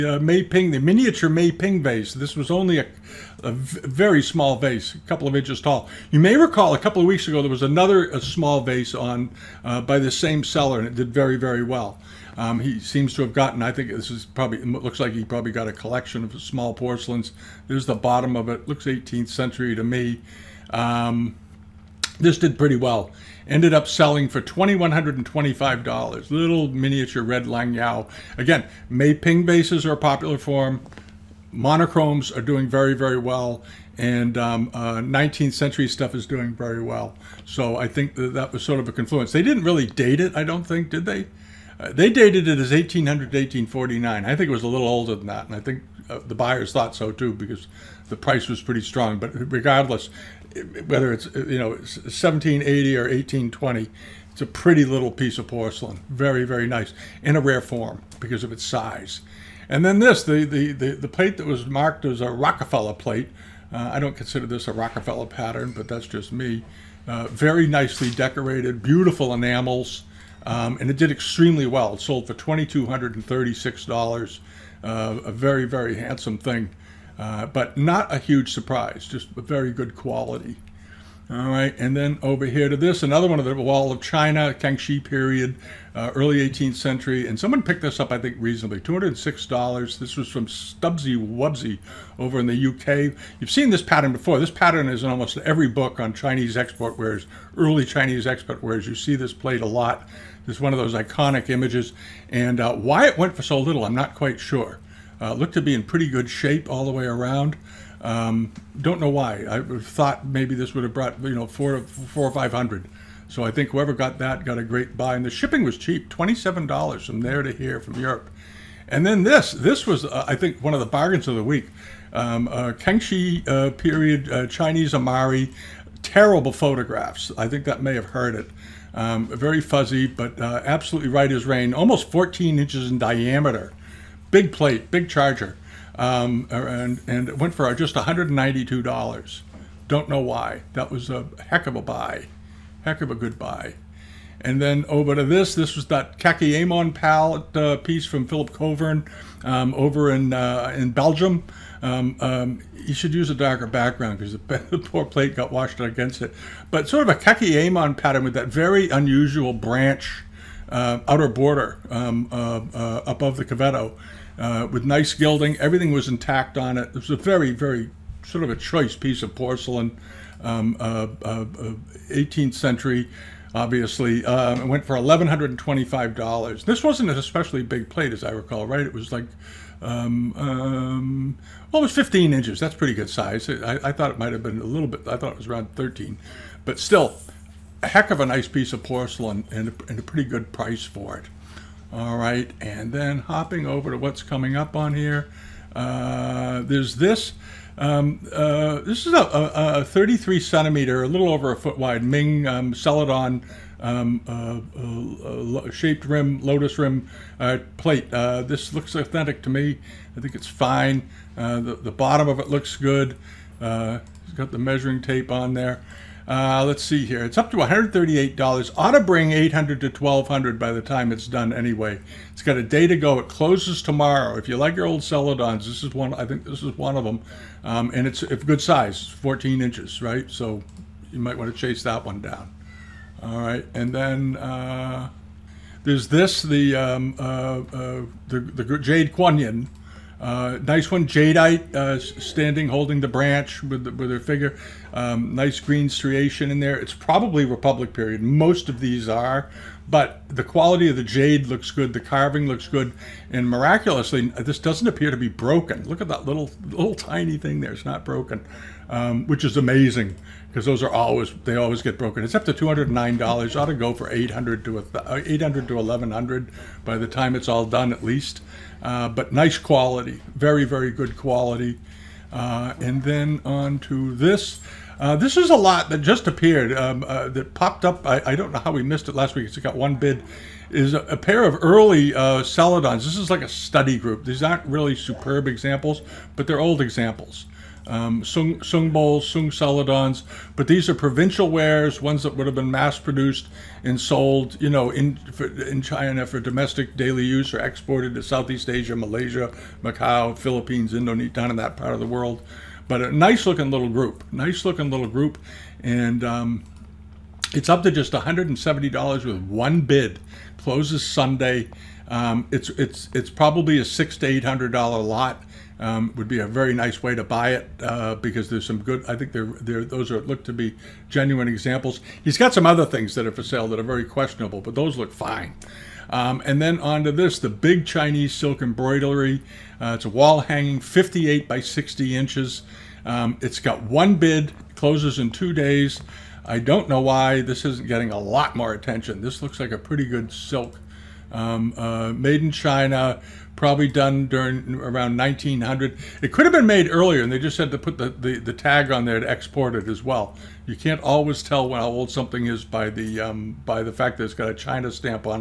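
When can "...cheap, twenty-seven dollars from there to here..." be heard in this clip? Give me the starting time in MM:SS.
01:55.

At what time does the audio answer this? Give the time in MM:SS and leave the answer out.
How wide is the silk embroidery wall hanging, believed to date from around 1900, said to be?
05:30.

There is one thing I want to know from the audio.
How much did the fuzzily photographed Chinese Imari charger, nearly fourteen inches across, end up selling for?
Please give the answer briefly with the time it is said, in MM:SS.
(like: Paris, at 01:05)
$192, at 02:17.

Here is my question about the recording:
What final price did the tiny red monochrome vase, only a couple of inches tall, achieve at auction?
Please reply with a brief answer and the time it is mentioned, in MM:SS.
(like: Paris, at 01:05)
$2,125, at 00:24.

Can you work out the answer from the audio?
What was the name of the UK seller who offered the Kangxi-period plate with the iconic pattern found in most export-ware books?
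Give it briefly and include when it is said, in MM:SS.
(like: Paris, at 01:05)
Stubbsy Wubsy, at 01:30.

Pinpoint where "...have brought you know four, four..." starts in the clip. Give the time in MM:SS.
01:50.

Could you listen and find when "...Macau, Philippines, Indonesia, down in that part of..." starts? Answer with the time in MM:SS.
04:59.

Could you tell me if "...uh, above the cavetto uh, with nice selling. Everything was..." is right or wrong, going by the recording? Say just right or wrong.
wrong.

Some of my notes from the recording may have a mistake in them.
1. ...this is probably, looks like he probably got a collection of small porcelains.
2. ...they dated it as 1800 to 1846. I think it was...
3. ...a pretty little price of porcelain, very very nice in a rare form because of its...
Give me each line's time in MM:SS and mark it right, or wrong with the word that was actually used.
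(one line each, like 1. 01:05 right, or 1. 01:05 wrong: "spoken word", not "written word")
1. 00:13 right
2. 00:41 wrong: "1849", not "1846"
3. 00:54 wrong: "piece", not "price".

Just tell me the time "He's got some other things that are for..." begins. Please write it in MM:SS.
05:22.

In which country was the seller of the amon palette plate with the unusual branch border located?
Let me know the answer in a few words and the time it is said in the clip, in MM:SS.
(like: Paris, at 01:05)
Belgium, at 02:30.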